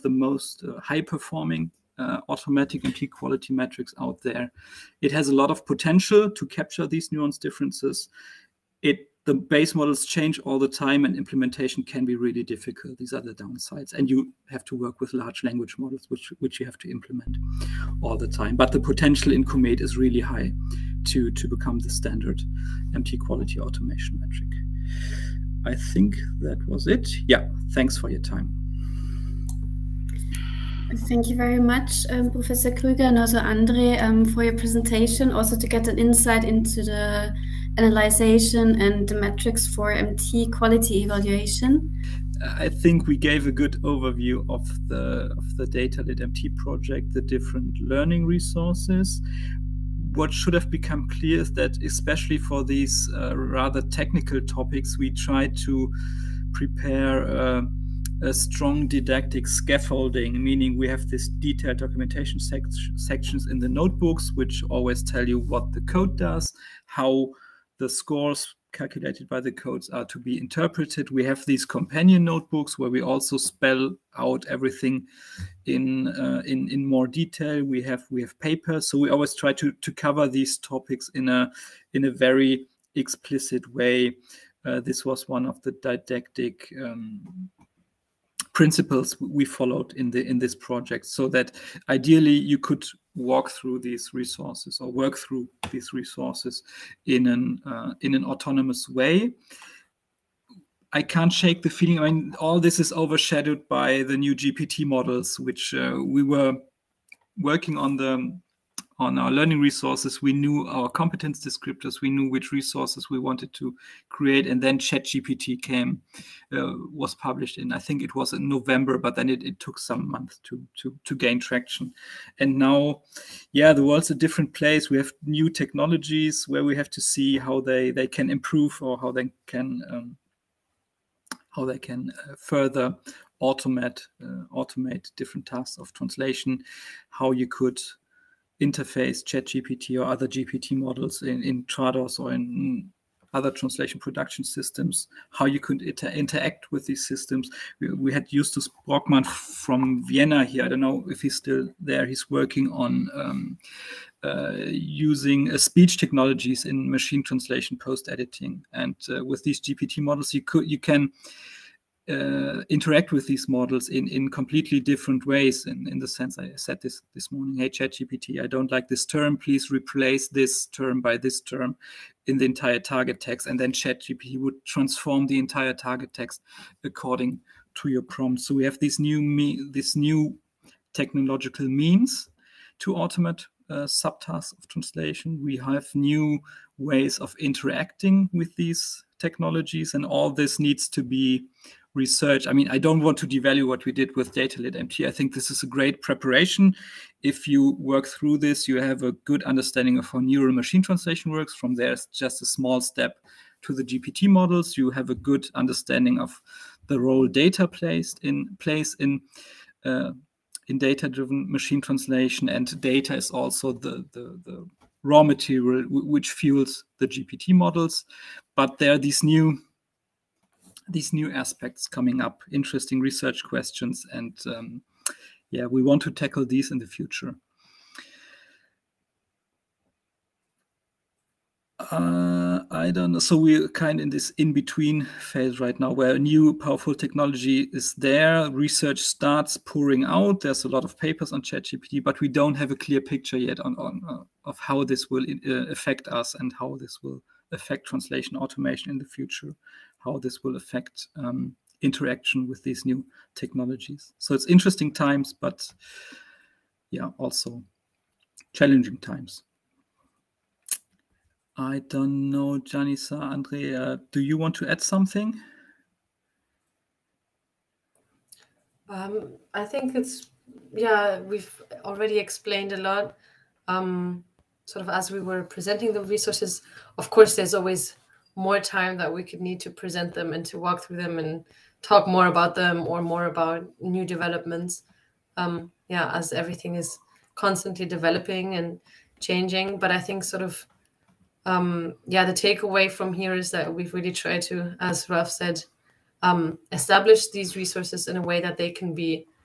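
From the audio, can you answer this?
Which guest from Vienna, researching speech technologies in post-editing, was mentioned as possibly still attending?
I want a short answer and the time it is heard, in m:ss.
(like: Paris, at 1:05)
Justus Brockmann, at 2:28.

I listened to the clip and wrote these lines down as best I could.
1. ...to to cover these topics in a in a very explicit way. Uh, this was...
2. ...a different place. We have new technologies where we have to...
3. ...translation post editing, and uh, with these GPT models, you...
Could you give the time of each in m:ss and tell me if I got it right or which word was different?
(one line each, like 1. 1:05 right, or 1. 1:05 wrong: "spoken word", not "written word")
1. 1:19 right
2. 2:04 right
3. 2:37 right.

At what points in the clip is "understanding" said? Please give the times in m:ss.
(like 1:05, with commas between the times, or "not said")
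3:19, 3:25.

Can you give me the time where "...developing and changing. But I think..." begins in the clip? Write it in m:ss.
4:47.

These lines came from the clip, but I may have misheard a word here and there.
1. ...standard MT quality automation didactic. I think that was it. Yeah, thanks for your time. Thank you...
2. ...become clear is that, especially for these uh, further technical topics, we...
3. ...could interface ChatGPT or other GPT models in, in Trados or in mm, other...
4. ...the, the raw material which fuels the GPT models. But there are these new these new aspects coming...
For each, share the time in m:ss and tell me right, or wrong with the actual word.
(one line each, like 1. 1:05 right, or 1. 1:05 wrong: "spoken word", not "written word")
1. 0:21 wrong: "metric", not "didactic"
2. 0:50 wrong: "rather", not "further"
3. 2:17 right
4. 3:34 right.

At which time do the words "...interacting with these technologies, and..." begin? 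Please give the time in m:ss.
3:07.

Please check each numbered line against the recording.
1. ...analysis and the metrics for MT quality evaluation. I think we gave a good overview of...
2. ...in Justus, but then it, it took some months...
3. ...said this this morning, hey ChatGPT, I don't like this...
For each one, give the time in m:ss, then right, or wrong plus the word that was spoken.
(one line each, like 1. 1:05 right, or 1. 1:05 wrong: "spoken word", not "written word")
1. 0:37 right
2. 1:58 wrong: "November", not "Justus"
3. 2:46 right.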